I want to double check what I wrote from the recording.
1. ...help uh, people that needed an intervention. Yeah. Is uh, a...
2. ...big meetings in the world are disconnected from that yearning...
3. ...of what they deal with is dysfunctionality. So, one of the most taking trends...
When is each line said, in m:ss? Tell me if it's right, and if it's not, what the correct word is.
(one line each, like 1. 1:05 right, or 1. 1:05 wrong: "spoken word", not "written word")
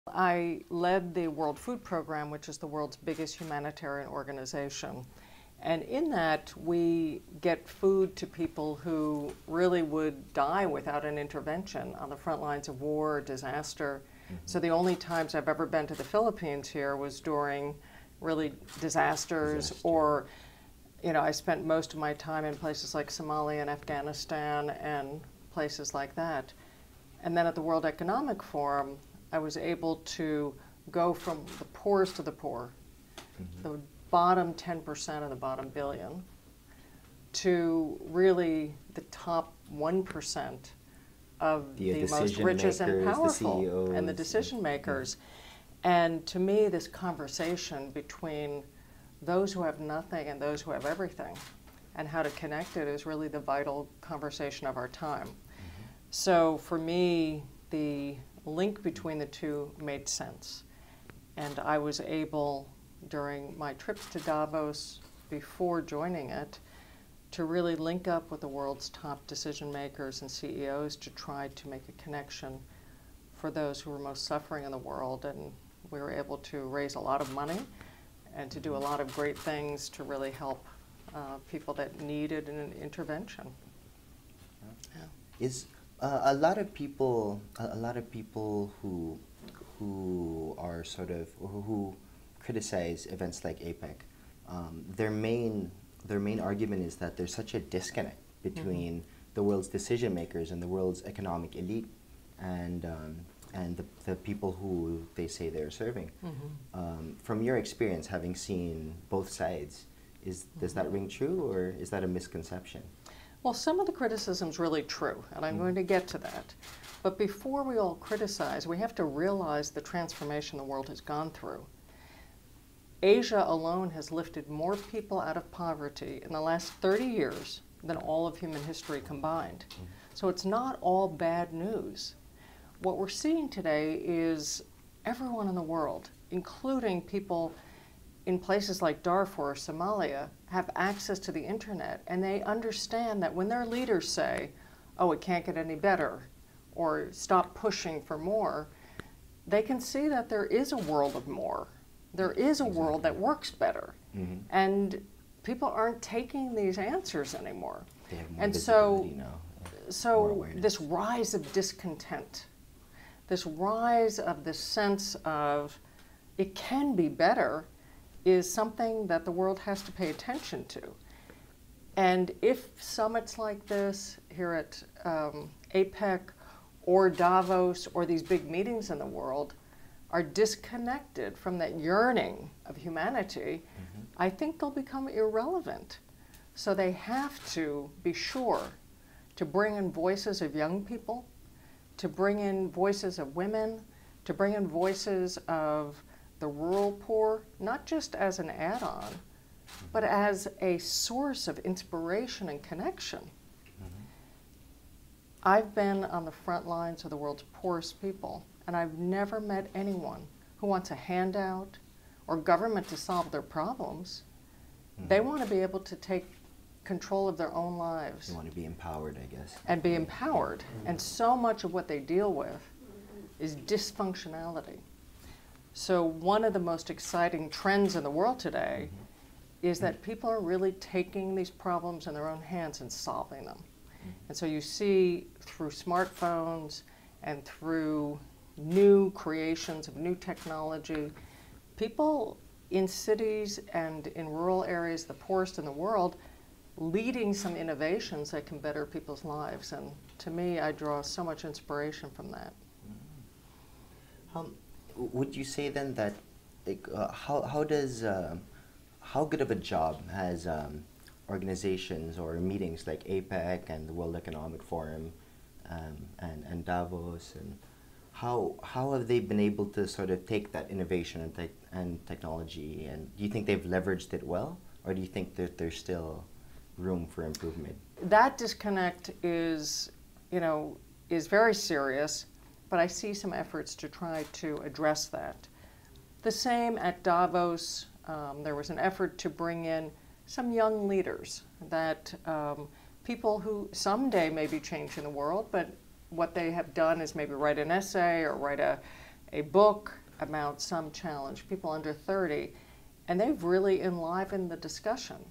1. 1:20 right
2. 2:58 right
3. 3:41 wrong: "exciting", not "taking".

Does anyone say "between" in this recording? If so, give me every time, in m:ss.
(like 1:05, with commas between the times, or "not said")
0:47, 0:58, 1:38.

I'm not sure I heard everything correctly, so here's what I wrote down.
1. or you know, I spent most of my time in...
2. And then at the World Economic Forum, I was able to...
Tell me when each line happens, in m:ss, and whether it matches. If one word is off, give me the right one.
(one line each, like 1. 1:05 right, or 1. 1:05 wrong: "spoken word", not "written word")
1. 0:19 right
2. 0:27 right.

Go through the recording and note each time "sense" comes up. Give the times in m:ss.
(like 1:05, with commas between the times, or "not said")
1:00, 2:44.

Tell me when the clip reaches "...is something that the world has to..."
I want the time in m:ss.
2:48.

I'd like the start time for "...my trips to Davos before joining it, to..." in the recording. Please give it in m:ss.
1:03.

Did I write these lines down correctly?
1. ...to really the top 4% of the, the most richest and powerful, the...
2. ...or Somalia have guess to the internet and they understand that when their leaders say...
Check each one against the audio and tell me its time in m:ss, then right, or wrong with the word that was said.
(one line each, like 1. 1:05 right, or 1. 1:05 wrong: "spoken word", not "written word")
1. 0:37 wrong: "1", not "4"
2. 2:19 wrong: "access", not "guess".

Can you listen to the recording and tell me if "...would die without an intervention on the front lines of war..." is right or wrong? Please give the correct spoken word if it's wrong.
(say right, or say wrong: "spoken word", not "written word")
right.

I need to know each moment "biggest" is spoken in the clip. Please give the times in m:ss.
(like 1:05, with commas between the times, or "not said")
0:02.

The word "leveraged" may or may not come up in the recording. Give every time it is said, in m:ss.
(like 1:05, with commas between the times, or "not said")
4:33.